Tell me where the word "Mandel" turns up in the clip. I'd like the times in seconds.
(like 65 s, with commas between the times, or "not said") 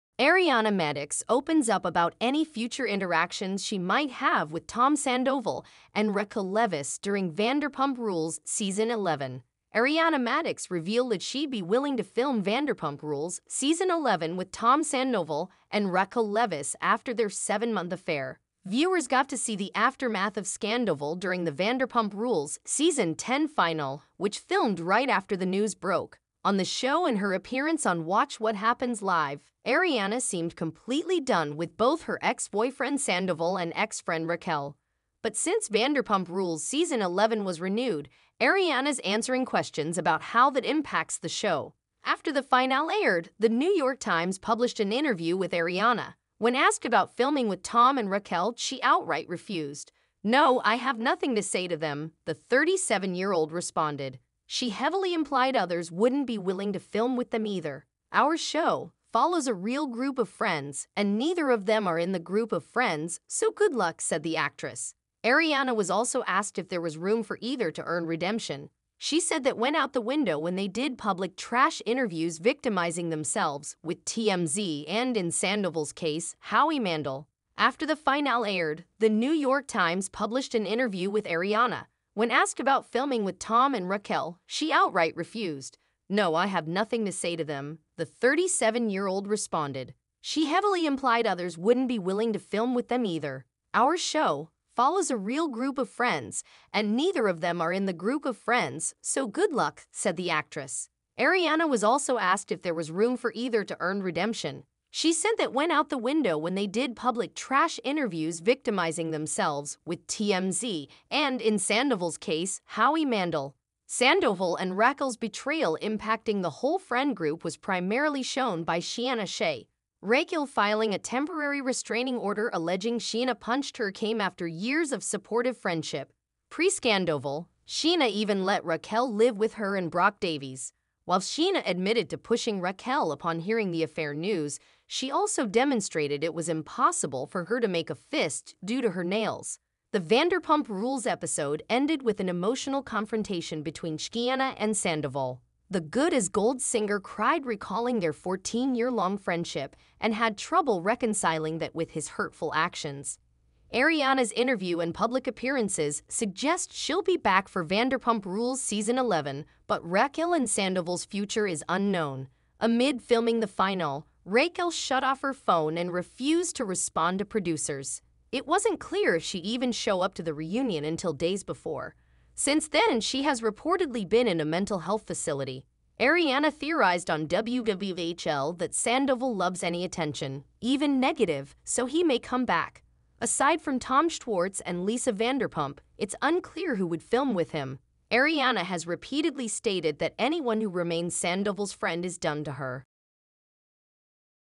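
76 s, 113 s.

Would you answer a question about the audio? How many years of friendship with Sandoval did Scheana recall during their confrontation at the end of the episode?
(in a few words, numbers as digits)
14.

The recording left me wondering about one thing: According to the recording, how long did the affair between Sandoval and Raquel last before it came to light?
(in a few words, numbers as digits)
7 months.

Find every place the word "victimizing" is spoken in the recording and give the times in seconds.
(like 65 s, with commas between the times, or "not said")
72 s, 108 s.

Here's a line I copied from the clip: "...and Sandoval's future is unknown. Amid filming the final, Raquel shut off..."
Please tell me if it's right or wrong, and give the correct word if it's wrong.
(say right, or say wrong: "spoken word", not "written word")
right.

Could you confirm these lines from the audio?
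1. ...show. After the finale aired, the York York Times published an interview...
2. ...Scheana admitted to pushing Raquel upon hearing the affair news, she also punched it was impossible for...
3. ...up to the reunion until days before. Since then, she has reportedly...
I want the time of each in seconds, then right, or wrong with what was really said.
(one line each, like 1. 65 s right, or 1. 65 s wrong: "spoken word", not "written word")
1. 41 s wrong: "New", not "York"
2. 131 s wrong: "demonstrated", not "punched"
3. 170 s right.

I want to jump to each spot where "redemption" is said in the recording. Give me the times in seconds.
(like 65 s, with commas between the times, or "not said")
68 s, 104 s.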